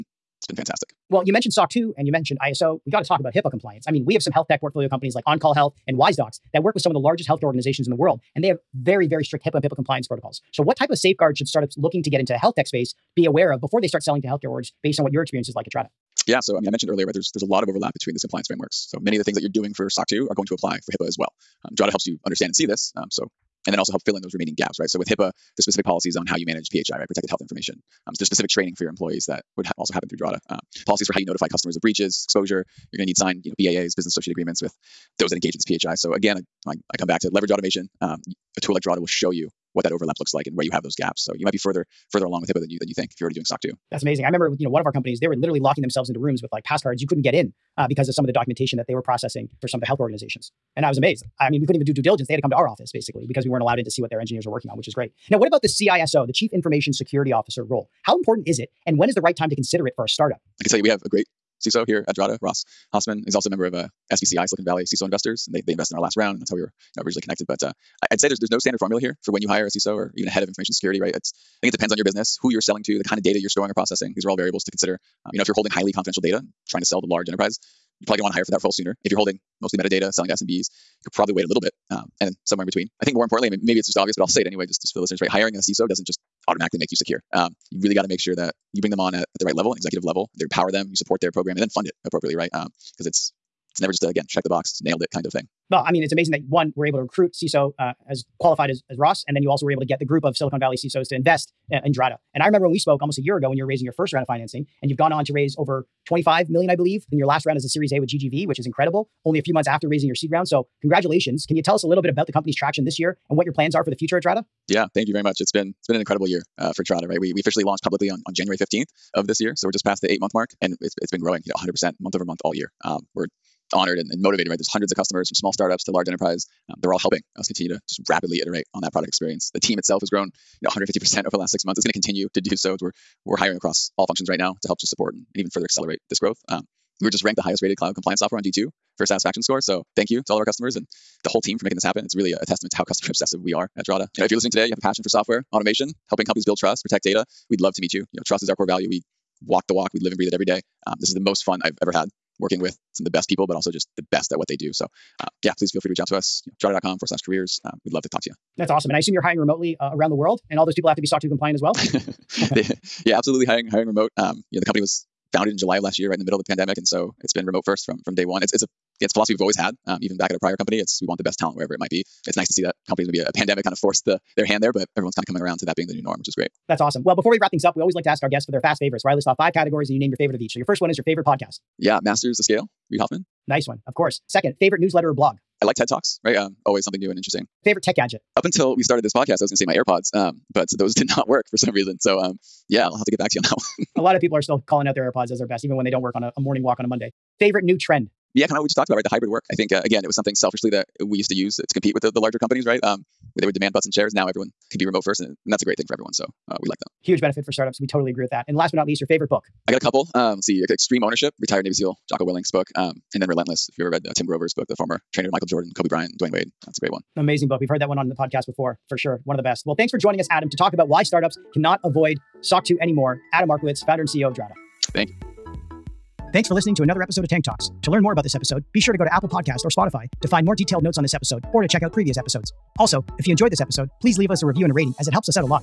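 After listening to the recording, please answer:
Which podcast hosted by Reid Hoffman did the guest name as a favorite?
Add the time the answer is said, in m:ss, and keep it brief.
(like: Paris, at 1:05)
Masters the Scale, at 3:02.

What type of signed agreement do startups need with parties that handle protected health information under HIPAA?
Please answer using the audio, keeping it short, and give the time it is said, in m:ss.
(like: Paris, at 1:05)
business associate agreements, at 0:33.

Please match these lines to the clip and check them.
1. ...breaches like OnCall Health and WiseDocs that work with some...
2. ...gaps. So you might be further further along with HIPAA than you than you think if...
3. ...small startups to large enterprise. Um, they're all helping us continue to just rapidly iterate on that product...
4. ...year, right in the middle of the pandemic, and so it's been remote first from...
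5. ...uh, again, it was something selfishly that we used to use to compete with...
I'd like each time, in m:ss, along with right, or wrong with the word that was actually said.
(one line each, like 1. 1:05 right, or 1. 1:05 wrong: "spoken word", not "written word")
1. 0:04 wrong: "companies", not "breaches"
2. 0:40 right
3. 2:05 right
4. 2:45 right
5. 3:19 right.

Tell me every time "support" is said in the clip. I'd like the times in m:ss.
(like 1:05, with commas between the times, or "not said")
1:30, 2:14.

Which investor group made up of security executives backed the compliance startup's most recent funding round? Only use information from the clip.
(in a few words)
Silicon Valley CISO Investors.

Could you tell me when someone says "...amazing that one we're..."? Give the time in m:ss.
1:36.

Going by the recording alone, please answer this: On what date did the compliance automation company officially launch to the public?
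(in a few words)
January 15th.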